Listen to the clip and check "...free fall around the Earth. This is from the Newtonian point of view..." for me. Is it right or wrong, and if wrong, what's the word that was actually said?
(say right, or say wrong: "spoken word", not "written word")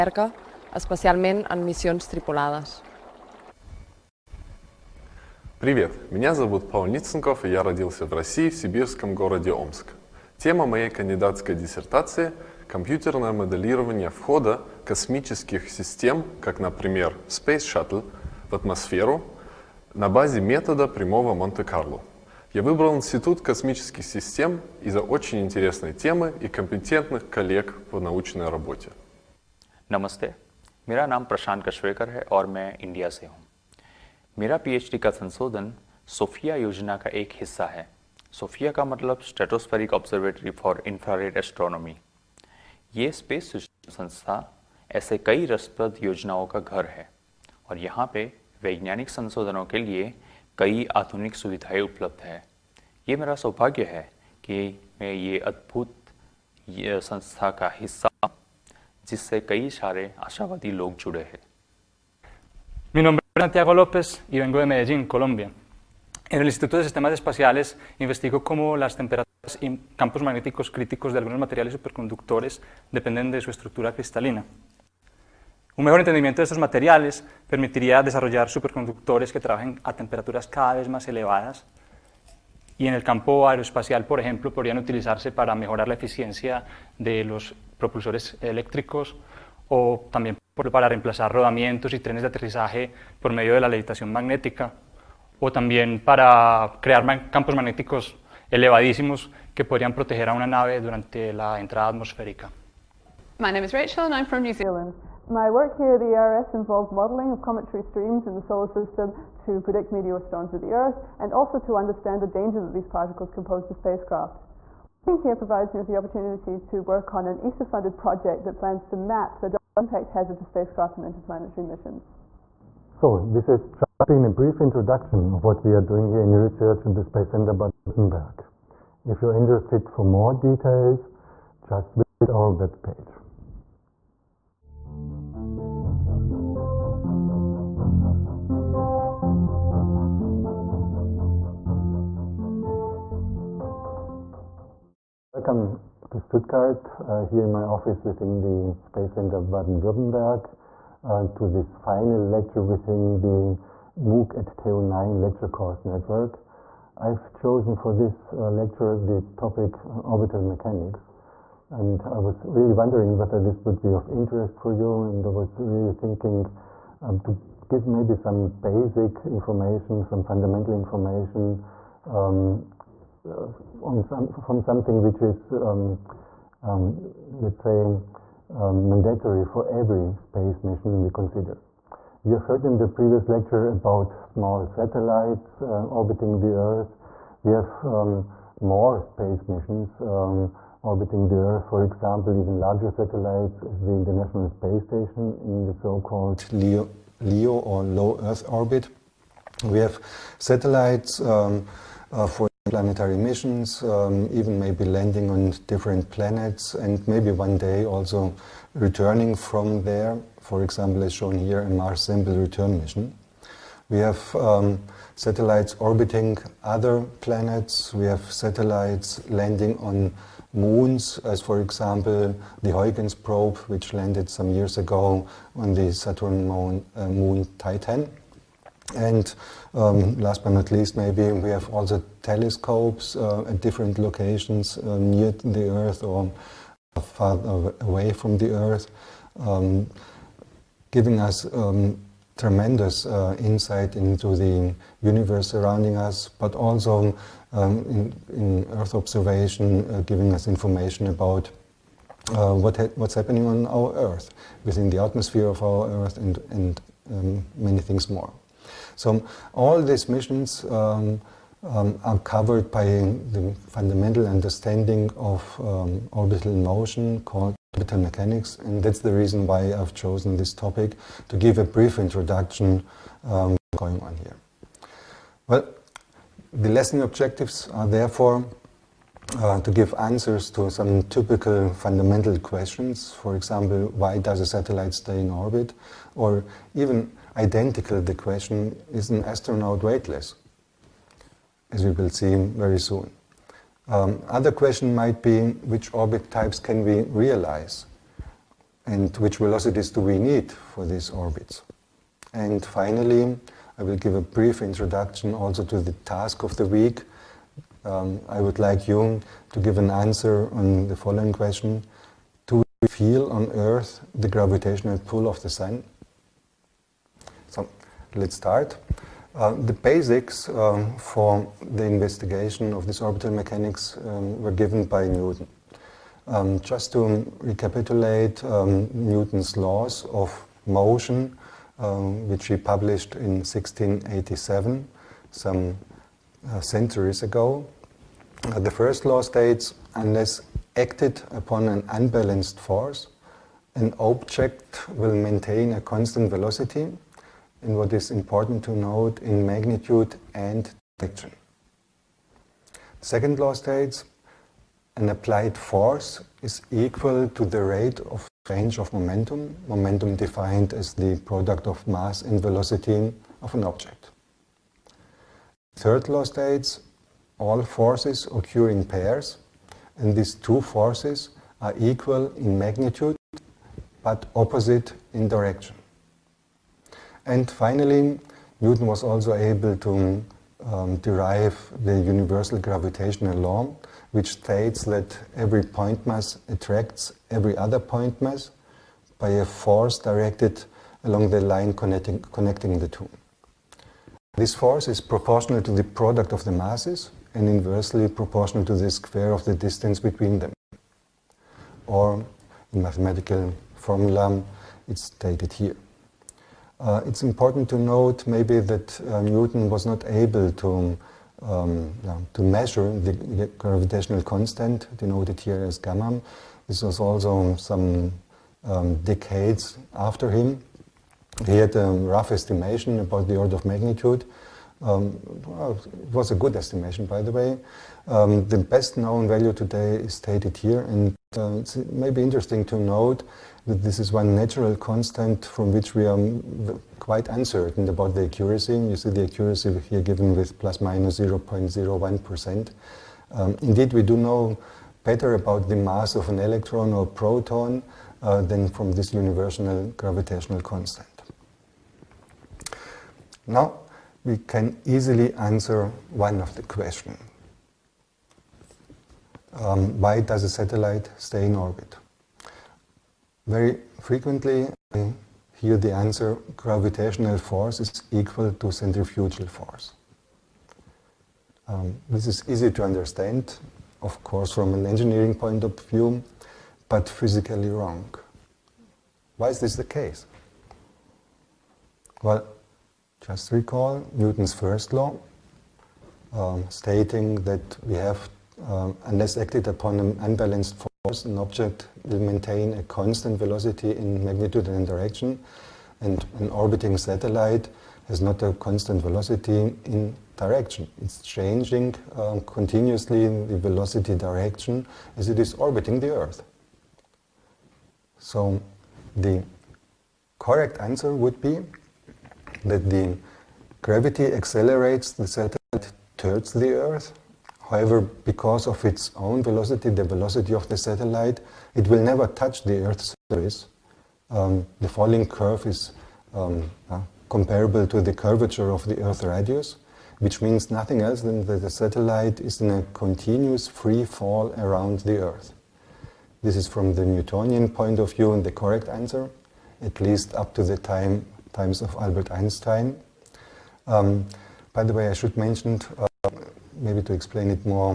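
right.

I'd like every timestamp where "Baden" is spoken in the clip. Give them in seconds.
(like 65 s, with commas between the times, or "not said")
127 s, 149 s.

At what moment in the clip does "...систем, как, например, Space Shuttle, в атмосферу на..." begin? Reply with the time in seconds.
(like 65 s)
15 s.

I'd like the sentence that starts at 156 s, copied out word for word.
I've chosen for this uh, lecture the topic orbital mechanics.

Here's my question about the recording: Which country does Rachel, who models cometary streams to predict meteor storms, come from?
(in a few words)
New Zealand.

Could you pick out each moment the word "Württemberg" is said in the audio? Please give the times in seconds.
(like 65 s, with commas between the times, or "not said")
127 s, 149 s.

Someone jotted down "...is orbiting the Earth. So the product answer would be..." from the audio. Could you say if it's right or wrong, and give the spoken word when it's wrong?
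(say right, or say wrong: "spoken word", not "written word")
wrong: "correct", not "product".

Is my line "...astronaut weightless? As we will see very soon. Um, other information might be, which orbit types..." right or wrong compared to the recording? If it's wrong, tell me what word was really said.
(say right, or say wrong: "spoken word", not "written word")
wrong: "question", not "information".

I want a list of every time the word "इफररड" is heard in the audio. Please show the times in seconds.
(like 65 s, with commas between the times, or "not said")
40 s.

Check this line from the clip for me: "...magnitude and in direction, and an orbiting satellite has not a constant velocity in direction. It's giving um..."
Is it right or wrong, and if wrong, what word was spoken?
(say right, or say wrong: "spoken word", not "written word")
wrong: "changing", not "giving".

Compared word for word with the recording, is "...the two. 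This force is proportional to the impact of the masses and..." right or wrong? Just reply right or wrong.
wrong.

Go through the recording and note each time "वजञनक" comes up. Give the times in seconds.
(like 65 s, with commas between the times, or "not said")
48 s.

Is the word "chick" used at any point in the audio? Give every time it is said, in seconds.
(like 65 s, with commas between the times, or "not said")
not said.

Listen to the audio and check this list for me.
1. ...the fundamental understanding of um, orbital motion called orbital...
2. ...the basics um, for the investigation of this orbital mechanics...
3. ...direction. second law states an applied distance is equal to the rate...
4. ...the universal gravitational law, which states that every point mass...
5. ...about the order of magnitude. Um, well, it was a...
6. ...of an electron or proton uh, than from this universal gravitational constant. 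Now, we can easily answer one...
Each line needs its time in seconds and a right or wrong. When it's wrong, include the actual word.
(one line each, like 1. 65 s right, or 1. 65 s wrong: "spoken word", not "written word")
1. 262 s right
2. 319 s right
3. 350 s wrong: "force", not "distance"
4. 381 s right
5. 423 s right
6. 446 s right.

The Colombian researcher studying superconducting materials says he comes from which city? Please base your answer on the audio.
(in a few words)
Medellín.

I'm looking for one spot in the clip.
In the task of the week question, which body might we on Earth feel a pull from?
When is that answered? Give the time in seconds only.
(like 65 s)
315 s.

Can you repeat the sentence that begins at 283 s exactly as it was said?
For example, why does a satellite stay in orbit?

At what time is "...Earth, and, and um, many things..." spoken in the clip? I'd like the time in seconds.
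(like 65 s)
255 s.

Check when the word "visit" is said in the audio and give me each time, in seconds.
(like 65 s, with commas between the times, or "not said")
131 s.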